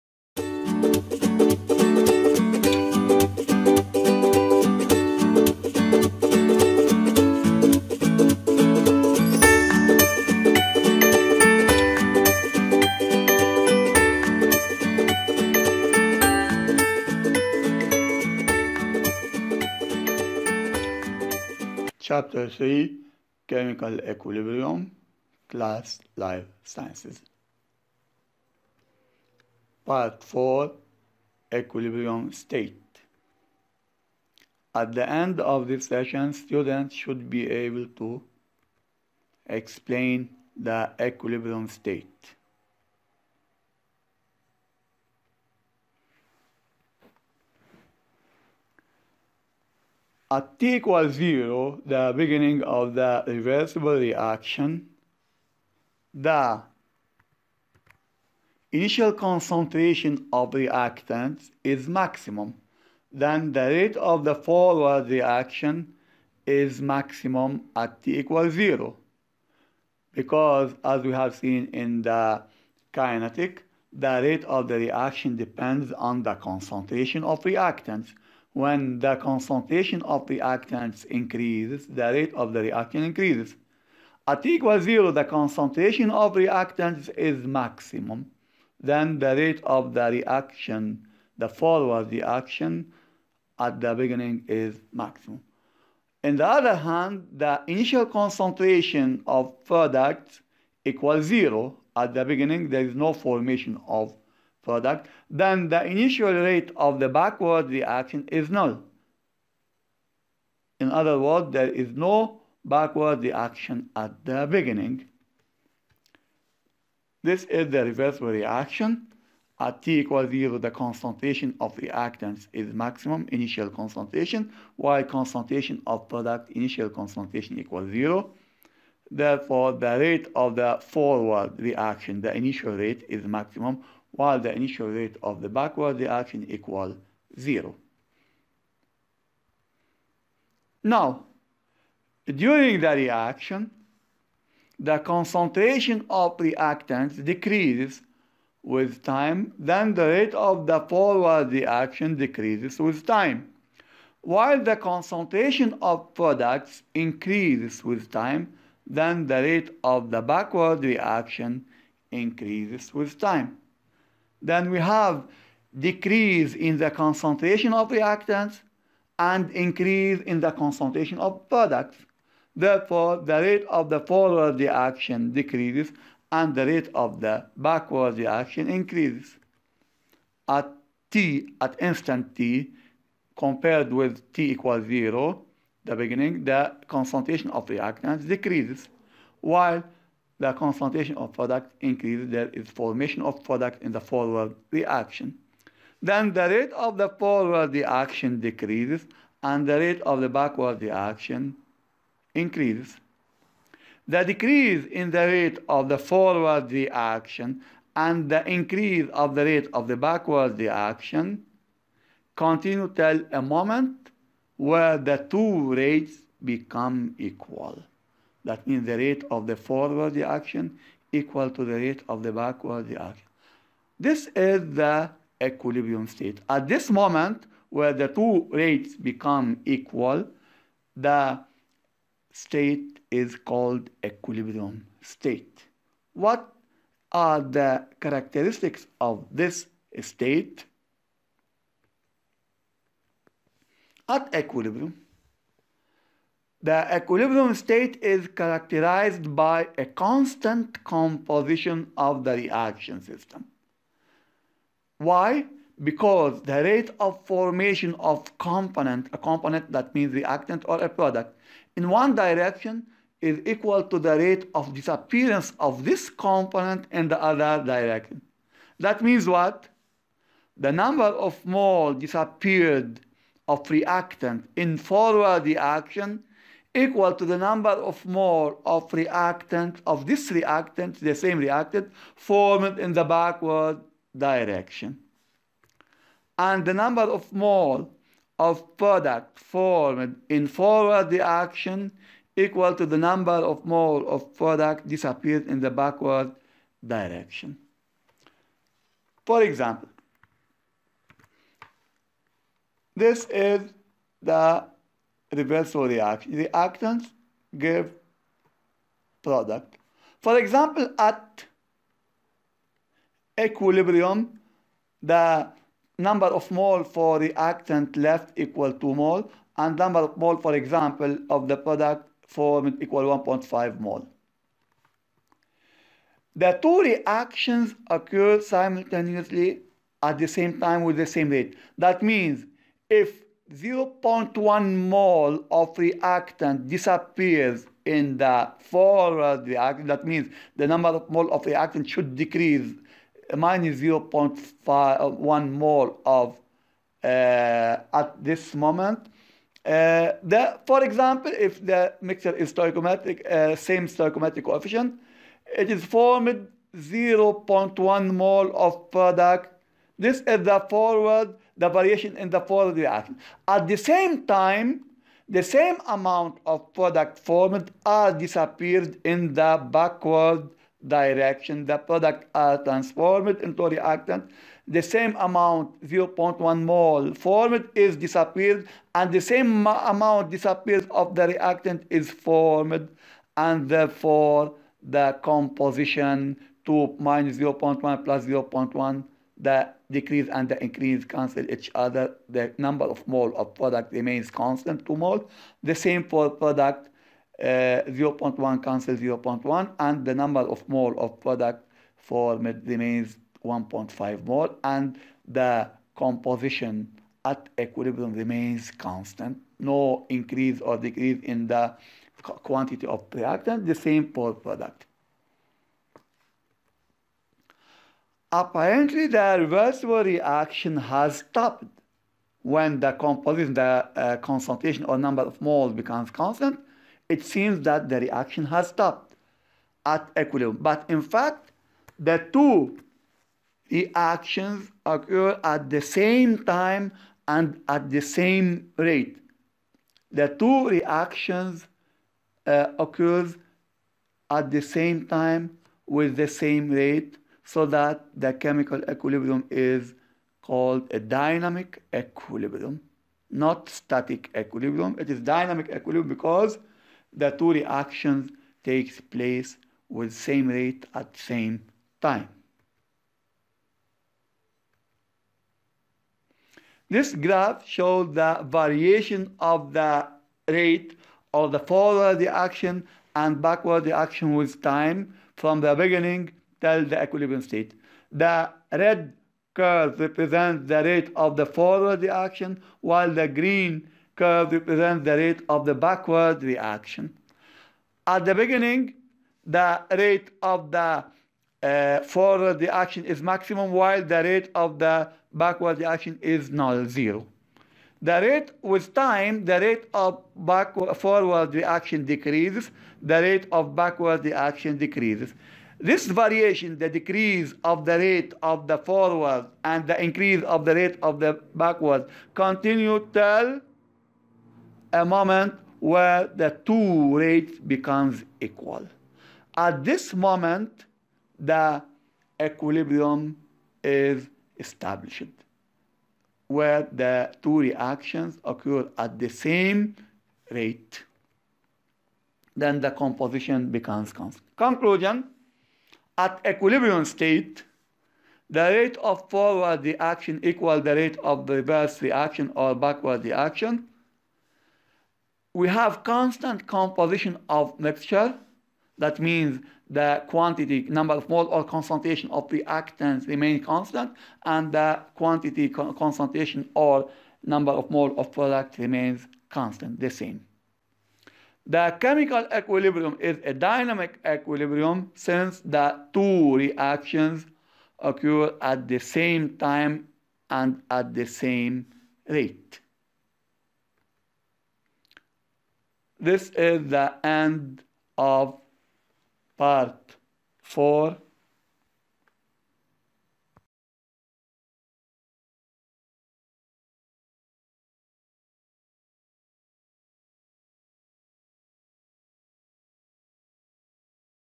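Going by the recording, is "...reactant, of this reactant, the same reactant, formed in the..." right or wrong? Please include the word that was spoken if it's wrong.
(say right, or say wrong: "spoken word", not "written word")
right.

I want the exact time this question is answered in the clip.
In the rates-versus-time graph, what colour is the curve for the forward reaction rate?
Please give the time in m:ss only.
7:58.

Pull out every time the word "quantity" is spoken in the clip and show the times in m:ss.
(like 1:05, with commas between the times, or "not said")
6:52, 9:10, 9:15.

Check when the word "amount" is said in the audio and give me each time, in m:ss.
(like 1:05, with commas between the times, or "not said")
6:05, 6:15, 6:19.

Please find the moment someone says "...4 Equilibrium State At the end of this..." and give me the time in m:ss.
0:30.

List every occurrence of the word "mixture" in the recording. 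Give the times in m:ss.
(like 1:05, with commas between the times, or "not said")
5:52, 9:07.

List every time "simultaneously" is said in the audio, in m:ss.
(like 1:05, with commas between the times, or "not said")
5:28.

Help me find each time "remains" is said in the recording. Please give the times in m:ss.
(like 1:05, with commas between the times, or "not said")
6:33, 6:42, 6:48, 9:13, 9:18.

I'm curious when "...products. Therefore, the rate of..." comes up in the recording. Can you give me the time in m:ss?
2:51.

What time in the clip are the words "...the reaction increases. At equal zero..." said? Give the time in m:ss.
1:22.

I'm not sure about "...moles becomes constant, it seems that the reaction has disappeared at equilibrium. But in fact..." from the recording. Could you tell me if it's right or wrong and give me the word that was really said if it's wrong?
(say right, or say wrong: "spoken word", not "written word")
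wrong: "stopped", not "disappeared".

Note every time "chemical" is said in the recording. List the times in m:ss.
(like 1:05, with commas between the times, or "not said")
0:23, 7:28, 9:21.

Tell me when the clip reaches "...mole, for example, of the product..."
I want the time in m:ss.
5:20.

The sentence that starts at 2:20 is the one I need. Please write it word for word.
Now, during the reaction, the concentration of reactants decreases with time, then the rate of the forward reaction decreases with time.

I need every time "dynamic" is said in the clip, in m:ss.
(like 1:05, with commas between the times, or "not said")
7:31, 7:35, 9:23.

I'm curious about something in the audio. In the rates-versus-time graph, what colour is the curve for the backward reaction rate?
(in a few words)
Green.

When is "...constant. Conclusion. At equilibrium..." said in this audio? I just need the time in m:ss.
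8:54.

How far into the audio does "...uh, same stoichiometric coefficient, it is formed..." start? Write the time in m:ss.
5:53.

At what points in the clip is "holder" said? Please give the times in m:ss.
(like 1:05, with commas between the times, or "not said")
not said.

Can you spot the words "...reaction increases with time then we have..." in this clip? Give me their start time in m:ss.
2:40.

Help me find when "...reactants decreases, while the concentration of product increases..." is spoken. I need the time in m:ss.
3:07.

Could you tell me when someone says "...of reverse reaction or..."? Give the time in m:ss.
9:01.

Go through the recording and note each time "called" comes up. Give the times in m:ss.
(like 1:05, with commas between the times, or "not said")
3:53, 7:30.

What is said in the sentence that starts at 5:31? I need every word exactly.
That means if 0.1 mole of reactant disappears in the forward reactant.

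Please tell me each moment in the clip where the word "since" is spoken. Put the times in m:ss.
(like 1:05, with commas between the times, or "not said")
9:25.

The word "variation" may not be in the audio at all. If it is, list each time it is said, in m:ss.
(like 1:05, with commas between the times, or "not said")
6:01, 7:48, 8:26.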